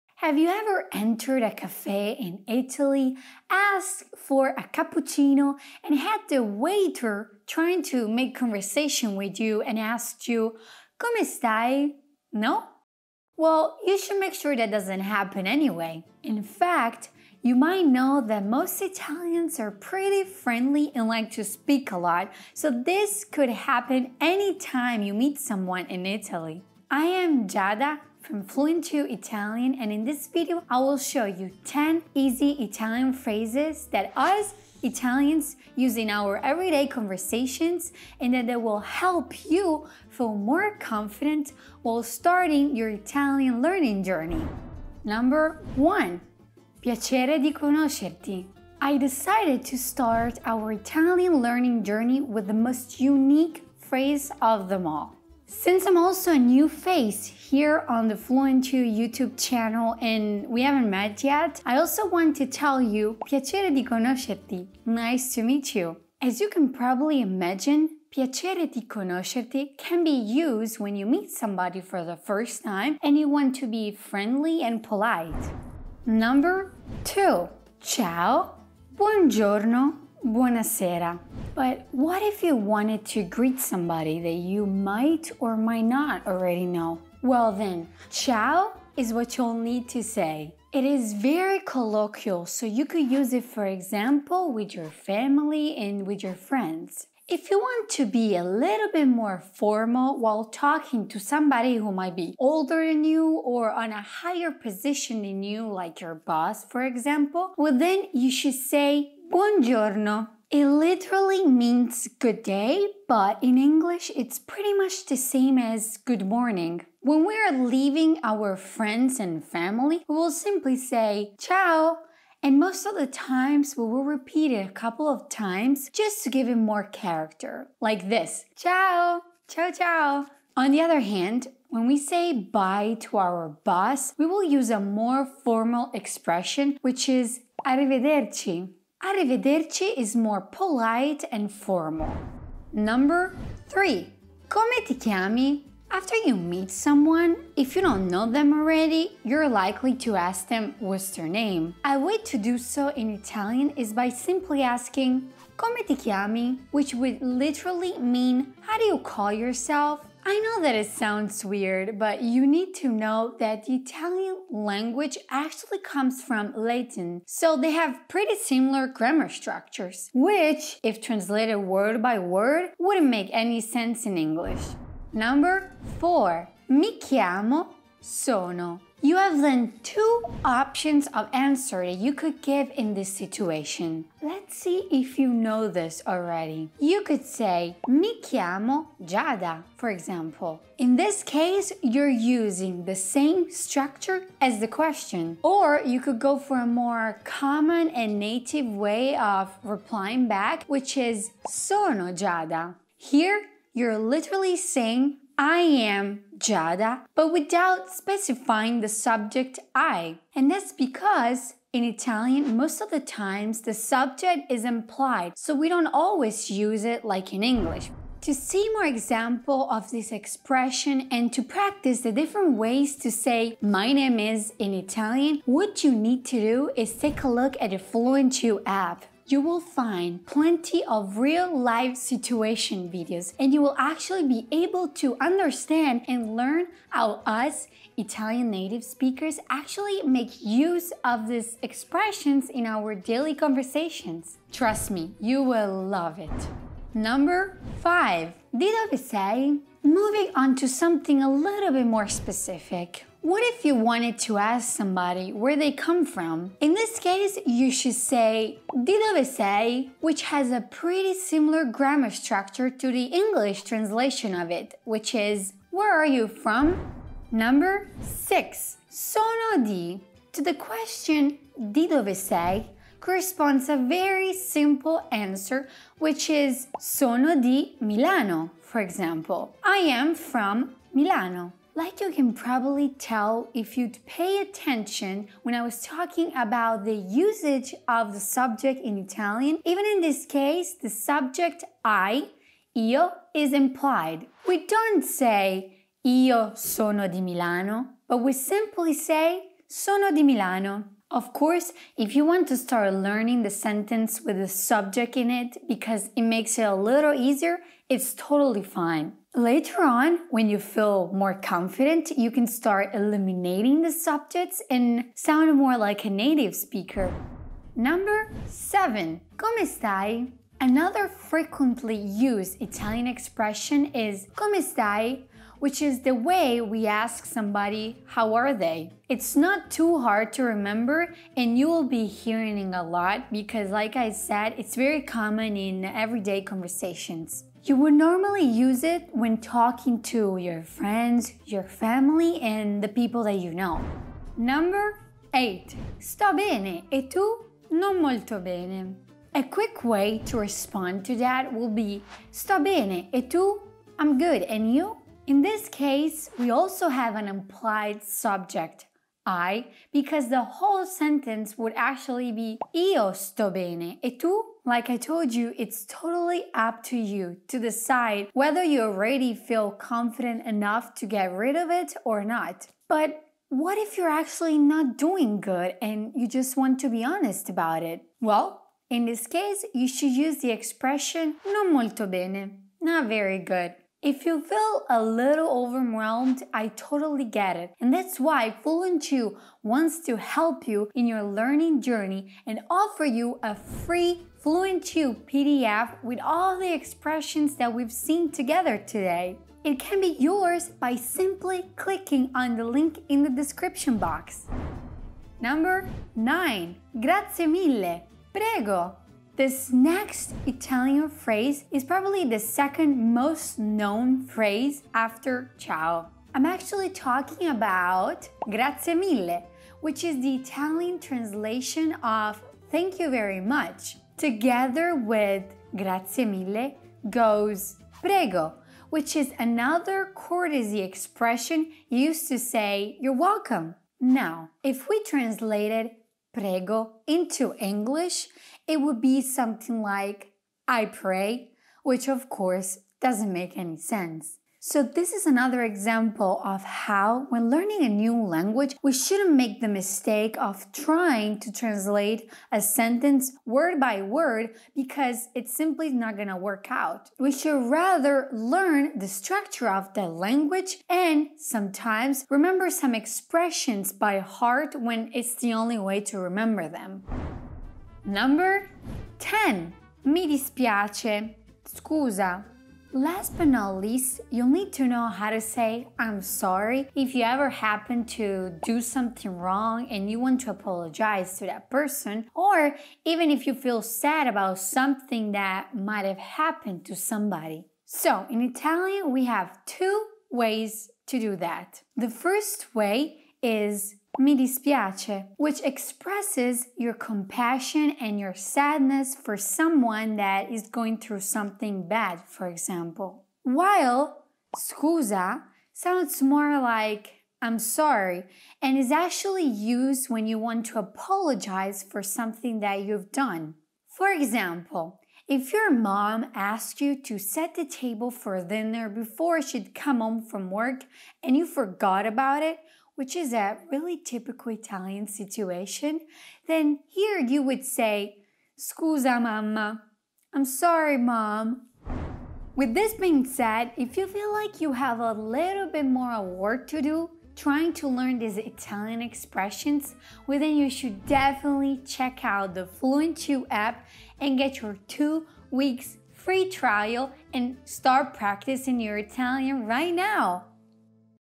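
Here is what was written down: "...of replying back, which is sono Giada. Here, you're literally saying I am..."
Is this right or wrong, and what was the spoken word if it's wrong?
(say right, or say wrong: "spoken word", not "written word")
right.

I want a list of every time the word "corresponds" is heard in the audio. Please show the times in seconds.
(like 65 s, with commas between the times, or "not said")
272 s.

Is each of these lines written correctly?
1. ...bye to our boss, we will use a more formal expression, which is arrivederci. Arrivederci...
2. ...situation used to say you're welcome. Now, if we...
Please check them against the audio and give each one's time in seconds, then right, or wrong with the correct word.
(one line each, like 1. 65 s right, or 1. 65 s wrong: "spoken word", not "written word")
1. 132 s right
2. 430 s wrong: "expression", not "situation".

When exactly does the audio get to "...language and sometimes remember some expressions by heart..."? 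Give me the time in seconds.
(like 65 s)
460 s.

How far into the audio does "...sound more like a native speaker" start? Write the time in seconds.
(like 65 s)
315 s.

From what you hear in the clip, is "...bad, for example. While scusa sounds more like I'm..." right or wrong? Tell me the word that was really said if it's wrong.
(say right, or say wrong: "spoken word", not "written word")
right.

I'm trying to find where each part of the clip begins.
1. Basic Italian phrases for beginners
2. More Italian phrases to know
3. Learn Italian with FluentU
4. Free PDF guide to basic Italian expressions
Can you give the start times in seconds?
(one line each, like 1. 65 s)
1. 45 s
2. 247 s
3. 218 s
4. 532 s.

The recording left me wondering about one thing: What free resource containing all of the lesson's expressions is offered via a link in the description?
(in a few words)
FluentU PDF.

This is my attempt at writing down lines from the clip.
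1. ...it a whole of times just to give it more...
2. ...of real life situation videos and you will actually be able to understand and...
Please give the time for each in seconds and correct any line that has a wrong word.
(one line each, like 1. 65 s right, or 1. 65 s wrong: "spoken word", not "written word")
1. 124 s wrong: "couple", not "whole"
2. 230 s right.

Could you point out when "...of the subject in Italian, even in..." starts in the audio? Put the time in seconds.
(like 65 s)
287 s.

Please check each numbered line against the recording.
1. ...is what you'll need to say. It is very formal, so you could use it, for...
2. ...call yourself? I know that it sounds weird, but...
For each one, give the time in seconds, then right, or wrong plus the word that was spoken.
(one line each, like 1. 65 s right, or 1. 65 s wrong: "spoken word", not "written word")
1. 88 s wrong: "colloquial", not "formal"
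2. 158 s right.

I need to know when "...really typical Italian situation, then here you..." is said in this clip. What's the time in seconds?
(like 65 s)
523 s.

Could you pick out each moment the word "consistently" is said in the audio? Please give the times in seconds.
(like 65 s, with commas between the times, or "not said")
not said.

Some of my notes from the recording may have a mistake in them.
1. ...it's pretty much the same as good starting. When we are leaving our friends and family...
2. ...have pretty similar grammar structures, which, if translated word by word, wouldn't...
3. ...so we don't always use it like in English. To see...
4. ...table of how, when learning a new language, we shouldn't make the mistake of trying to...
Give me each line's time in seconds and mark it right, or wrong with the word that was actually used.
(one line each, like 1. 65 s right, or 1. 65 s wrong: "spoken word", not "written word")
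1. 114 s wrong: "morning", not "starting"
2. 167 s right
3. 215 s right
4. 445 s wrong: "example", not "table".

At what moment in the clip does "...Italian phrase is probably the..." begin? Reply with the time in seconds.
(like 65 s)
410 s.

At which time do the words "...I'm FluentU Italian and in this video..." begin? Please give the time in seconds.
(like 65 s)
28 s.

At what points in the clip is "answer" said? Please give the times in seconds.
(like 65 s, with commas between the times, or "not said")
181 s, 275 s.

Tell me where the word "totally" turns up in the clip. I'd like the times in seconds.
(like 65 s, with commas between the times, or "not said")
308 s, 365 s, 386 s.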